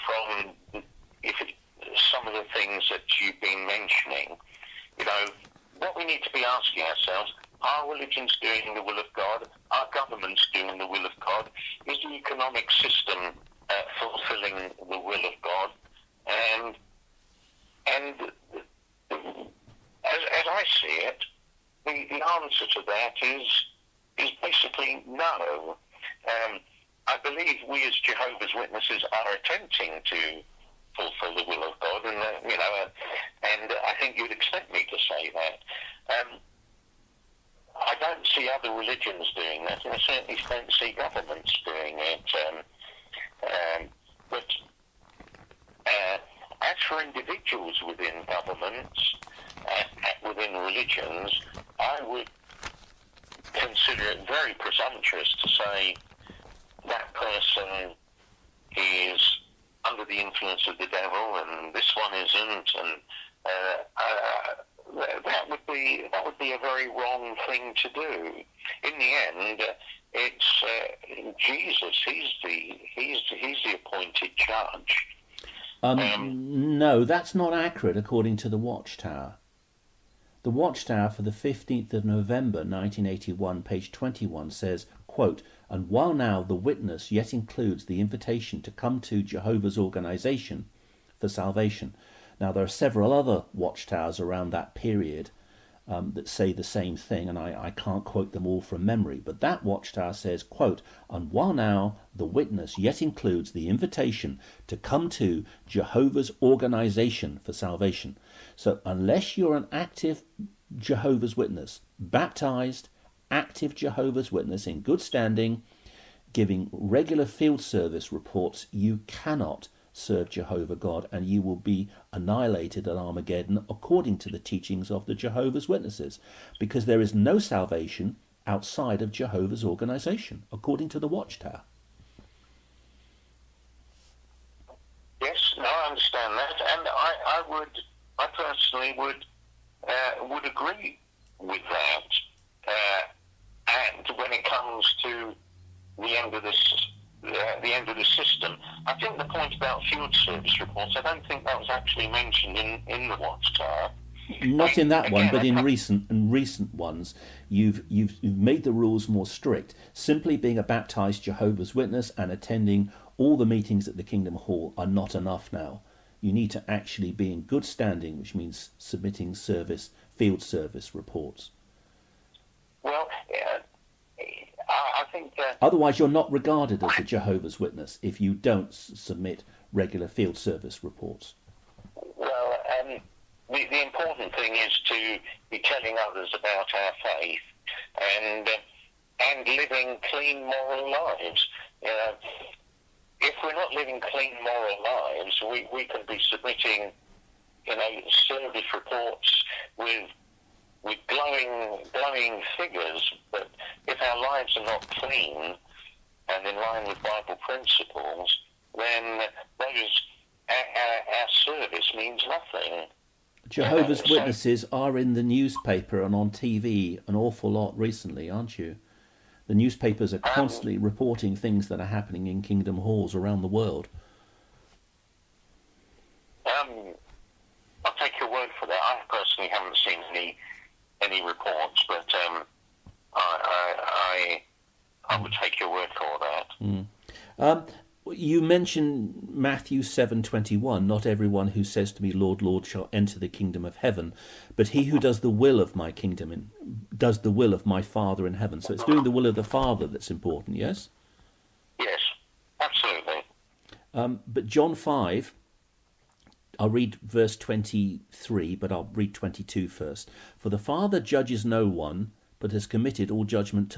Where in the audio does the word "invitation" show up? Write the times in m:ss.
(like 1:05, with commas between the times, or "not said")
1:27, 1:43.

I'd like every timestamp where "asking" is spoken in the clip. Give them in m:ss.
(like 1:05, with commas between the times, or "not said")
0:06.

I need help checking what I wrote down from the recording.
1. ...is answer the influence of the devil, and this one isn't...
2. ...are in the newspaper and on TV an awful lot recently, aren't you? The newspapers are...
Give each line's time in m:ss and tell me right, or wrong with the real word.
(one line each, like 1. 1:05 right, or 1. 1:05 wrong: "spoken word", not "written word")
1. 0:58 wrong: "under", not "answer"
2. 3:34 right.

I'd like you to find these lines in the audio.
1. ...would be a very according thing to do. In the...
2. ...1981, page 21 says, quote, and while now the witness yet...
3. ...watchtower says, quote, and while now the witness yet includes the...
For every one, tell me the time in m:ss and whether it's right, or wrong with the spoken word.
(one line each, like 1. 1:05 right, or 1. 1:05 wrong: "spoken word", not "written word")
1. 1:06 wrong: "wrong", not "according"
2. 1:22 right
3. 1:39 right.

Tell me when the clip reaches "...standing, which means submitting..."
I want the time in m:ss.
2:47.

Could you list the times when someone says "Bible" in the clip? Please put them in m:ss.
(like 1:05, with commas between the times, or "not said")
3:27.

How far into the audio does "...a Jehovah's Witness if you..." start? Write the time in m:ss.
2:56.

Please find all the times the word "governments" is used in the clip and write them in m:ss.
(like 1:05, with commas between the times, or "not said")
0:09, 0:40, 0:48.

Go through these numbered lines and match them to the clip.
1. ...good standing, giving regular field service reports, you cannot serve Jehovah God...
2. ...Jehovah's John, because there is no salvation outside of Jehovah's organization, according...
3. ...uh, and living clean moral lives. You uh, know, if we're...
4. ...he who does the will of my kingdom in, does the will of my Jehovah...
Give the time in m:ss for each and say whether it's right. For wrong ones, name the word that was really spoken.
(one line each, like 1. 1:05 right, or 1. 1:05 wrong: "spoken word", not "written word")
1. 1:54 right
2. 2:05 wrong: "Witnesses", not "John"
3. 3:08 right
4. 4:04 wrong: "Father", not "Jehovah".